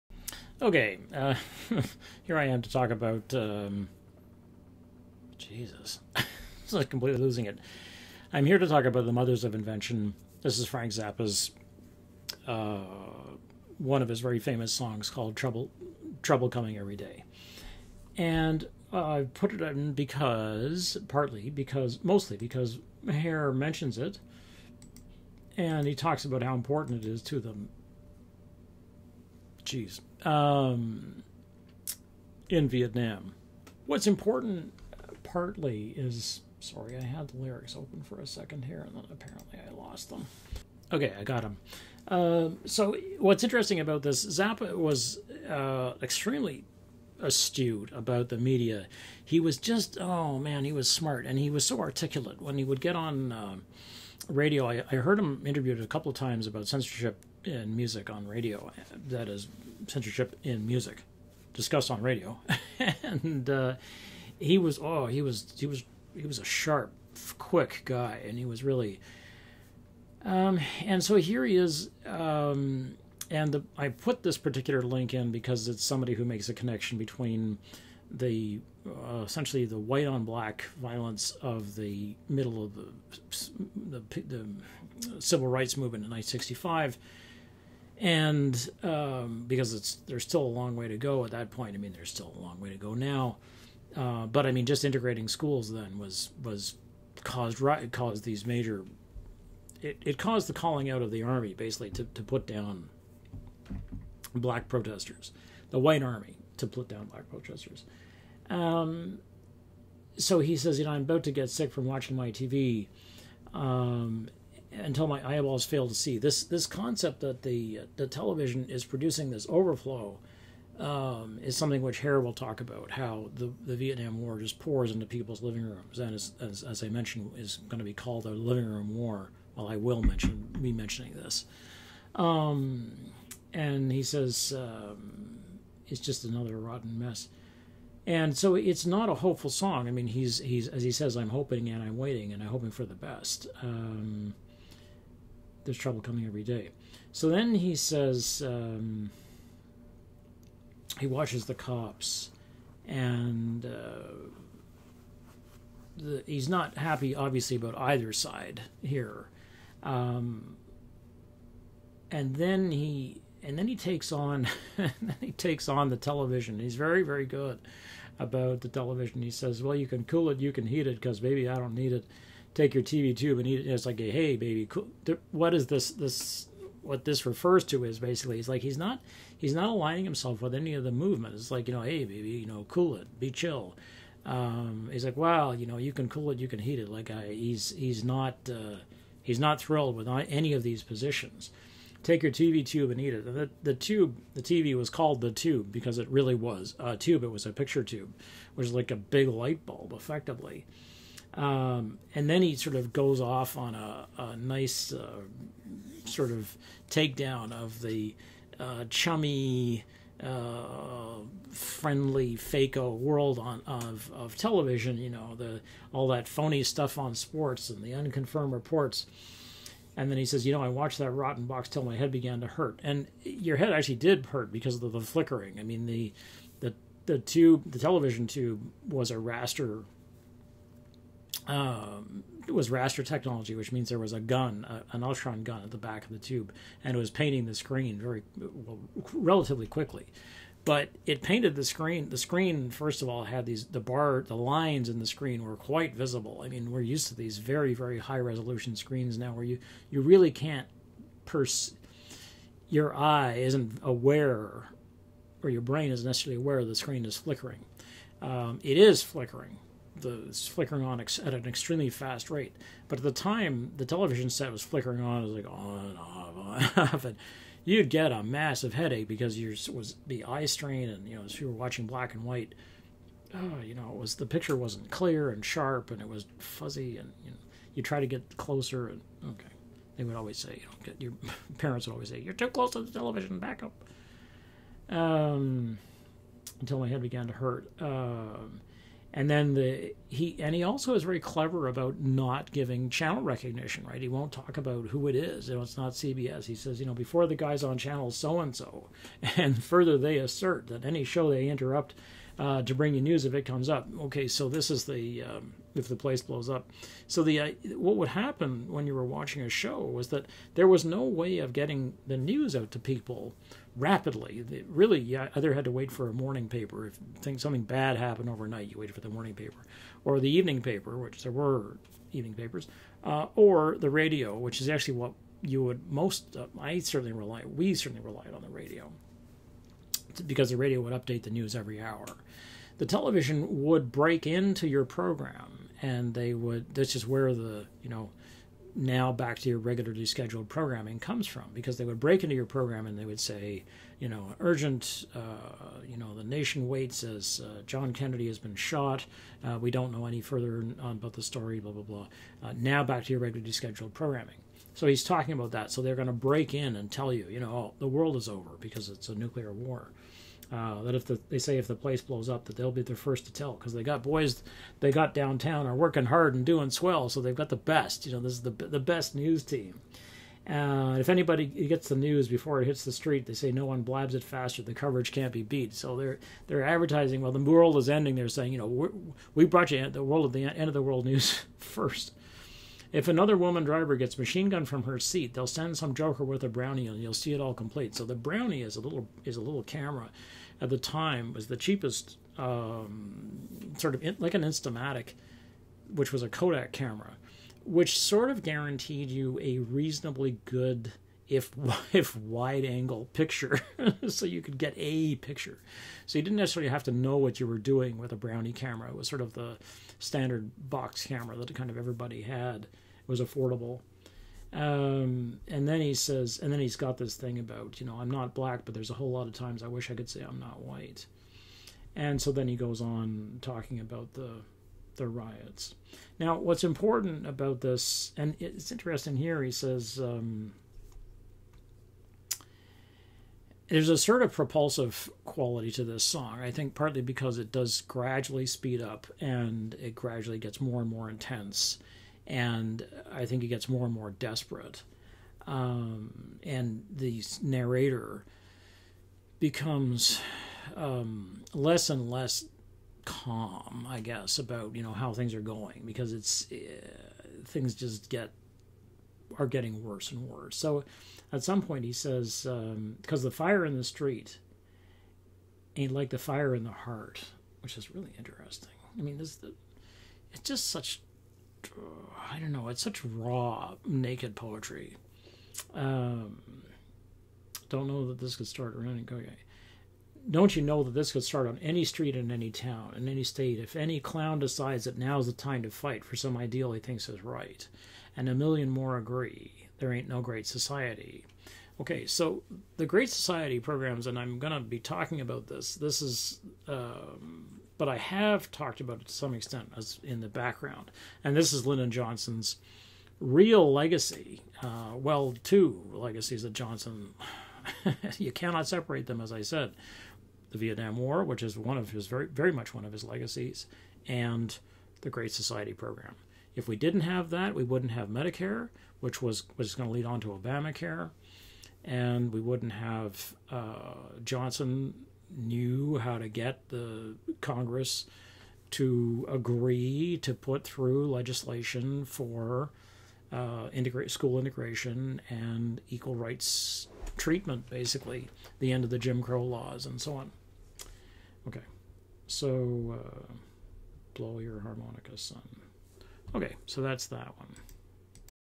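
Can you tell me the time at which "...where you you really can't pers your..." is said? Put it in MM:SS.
04:09.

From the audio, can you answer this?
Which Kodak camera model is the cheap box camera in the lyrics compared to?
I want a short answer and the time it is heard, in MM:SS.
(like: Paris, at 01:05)
Instamatic, at 06:34.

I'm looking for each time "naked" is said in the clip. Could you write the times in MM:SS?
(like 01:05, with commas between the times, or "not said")
07:53.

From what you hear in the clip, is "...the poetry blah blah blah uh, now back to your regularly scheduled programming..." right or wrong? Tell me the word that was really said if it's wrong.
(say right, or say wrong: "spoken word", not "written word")
wrong: "story", not "poetry".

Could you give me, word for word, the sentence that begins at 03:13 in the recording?
And the, the tube, the TV was called the tube because it really was a tube.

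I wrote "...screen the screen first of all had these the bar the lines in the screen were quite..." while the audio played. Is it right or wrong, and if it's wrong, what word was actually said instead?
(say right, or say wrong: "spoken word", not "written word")
right.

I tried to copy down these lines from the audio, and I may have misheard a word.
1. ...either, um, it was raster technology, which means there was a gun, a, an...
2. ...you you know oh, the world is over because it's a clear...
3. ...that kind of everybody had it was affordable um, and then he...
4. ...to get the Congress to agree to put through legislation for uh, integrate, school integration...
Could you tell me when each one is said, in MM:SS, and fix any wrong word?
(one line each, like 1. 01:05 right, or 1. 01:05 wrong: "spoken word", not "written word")
1. 03:49 wrong: "raster", not "either"
2. 05:57 wrong: "nuclear", not "clear"
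3. 06:51 right
4. 08:46 right.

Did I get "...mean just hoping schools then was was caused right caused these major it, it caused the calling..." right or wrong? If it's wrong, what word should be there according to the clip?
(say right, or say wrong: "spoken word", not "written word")
wrong: "integrating", not "hoping".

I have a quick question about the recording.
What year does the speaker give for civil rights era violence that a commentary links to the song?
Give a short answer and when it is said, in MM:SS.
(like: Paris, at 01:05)
1965, at 01:26.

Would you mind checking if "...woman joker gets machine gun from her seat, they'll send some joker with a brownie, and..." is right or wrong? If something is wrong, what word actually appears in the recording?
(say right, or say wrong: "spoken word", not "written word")
wrong: "driver", not "joker".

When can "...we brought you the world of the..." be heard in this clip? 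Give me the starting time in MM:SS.
06:19.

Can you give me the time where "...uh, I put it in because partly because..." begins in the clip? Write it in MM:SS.
00:18.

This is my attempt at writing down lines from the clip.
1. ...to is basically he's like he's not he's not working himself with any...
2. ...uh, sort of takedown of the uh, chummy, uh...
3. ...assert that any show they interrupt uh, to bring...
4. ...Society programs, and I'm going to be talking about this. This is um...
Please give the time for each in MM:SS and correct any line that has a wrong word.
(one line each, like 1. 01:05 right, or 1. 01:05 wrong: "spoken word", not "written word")
1. 02:57 wrong: "aligning", not "working"
2. 03:24 right
3. 05:00 right
4. 08:13 right.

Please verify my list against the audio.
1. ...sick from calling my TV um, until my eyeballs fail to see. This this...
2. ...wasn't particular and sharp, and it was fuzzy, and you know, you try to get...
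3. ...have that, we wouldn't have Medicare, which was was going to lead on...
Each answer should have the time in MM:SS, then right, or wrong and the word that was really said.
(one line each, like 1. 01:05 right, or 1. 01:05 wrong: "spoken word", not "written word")
1. 01:51 wrong: "watching", not "calling"
2. 04:34 wrong: "clear", not "particular"
3. 08:37 right.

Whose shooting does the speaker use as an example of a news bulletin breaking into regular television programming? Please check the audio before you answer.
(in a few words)
John Kennedy.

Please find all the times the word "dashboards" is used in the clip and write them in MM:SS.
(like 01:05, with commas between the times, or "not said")
not said.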